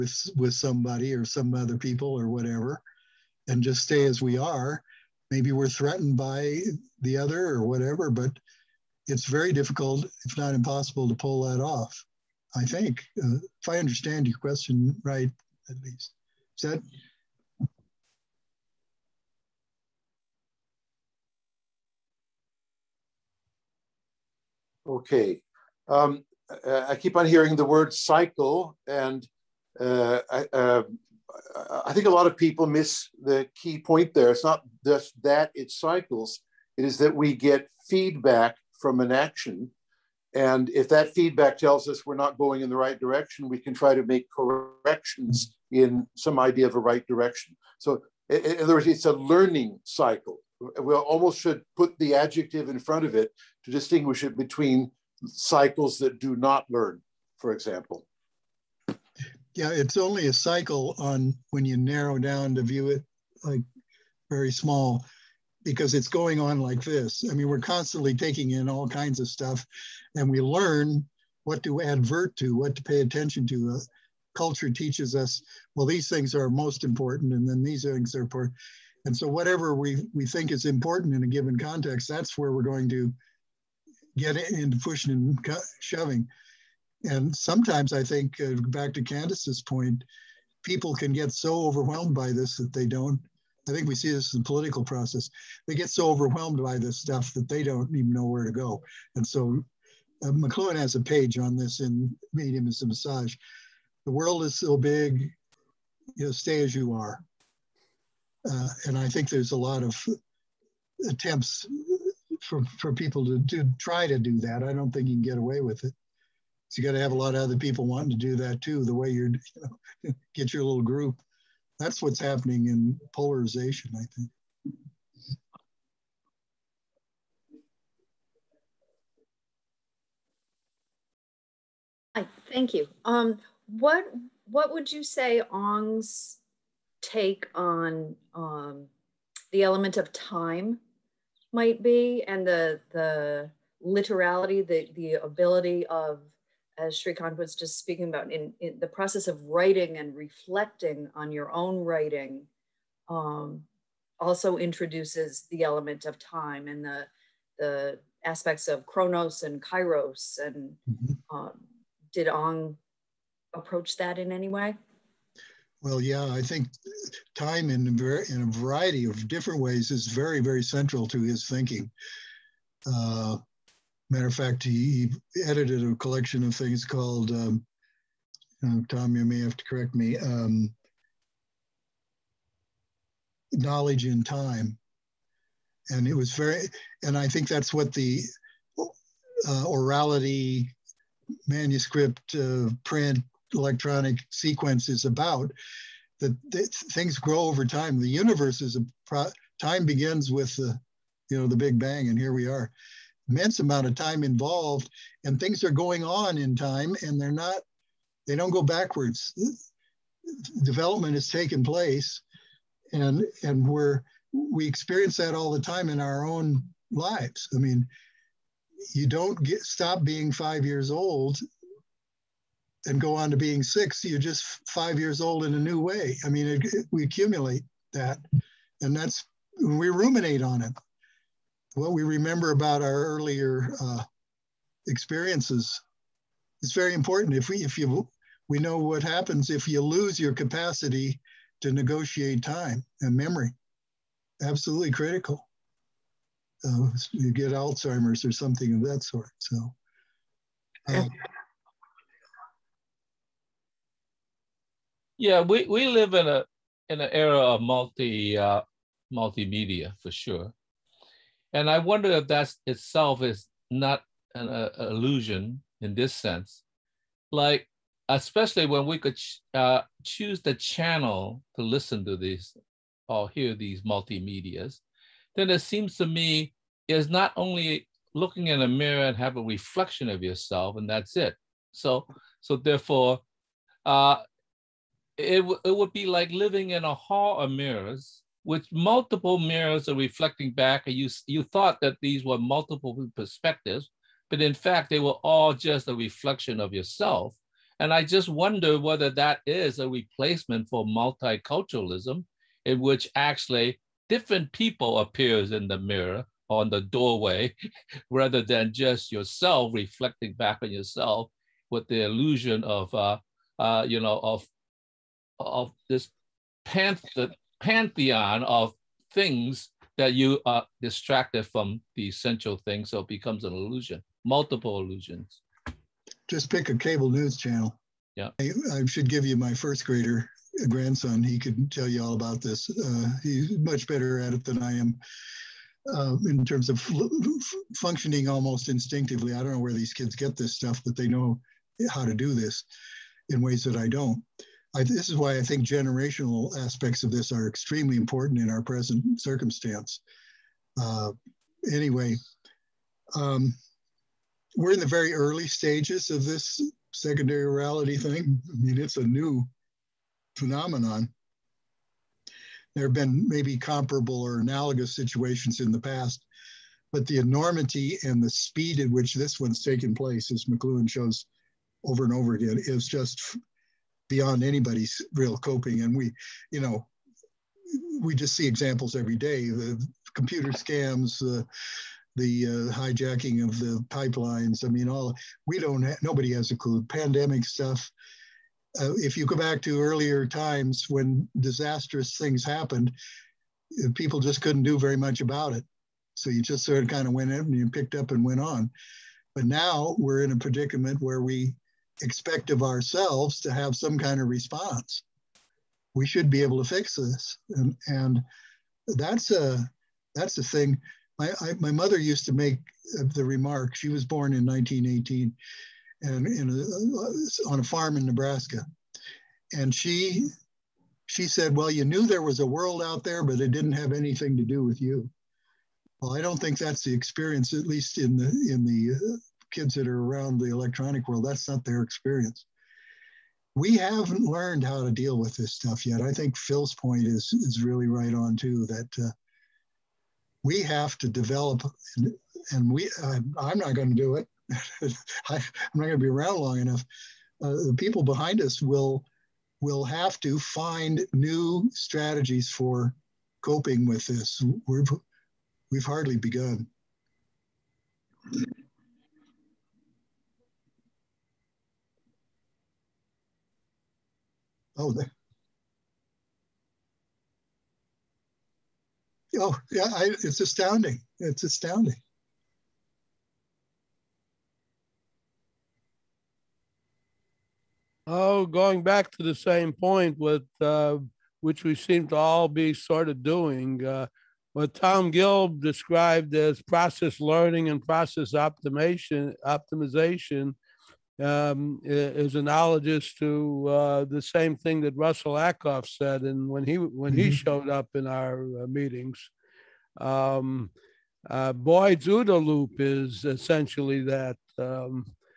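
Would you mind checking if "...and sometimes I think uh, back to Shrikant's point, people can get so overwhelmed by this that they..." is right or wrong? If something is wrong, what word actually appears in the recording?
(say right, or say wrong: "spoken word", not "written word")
wrong: "Candace", not "Shrikant".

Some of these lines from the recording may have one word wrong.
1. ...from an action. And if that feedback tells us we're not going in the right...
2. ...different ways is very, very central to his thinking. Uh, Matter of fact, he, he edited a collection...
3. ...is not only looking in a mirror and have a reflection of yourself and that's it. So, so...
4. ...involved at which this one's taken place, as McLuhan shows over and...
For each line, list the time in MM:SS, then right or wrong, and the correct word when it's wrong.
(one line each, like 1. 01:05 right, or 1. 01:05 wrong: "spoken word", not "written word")
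1. 00:38 right
2. 02:49 right
3. 04:36 right
4. 06:08 wrong: "speed", not "involved".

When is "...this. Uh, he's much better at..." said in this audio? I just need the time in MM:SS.
05:32.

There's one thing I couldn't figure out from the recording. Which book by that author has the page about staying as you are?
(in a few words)
Medium is a Massage.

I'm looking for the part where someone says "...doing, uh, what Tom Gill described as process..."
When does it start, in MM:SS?
08:03.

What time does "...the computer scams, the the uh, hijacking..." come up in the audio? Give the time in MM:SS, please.
06:19.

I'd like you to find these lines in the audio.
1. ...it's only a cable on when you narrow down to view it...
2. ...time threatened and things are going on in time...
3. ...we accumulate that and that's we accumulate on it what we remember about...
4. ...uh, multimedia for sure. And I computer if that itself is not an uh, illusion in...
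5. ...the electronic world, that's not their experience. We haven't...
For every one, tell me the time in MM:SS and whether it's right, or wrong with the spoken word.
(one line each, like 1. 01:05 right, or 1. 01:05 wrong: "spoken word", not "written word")
1. 00:59 wrong: "cycle", not "cable"
2. 03:23 wrong: "involved", not "threatened"
3. 03:46 wrong: "ruminate", not "accumulate"
4. 04:18 wrong: "wonder", not "computer"
5. 07:10 right.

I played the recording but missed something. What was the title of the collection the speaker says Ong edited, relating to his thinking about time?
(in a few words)
Knowledge in Time.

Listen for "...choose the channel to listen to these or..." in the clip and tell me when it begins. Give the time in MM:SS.
04:30.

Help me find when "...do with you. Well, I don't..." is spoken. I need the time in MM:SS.
07:04.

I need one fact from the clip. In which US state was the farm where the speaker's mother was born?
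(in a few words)
Nebraska.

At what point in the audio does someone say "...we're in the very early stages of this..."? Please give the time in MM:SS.
05:54.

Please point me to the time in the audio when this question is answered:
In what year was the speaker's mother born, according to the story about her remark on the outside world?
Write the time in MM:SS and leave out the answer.
06:54.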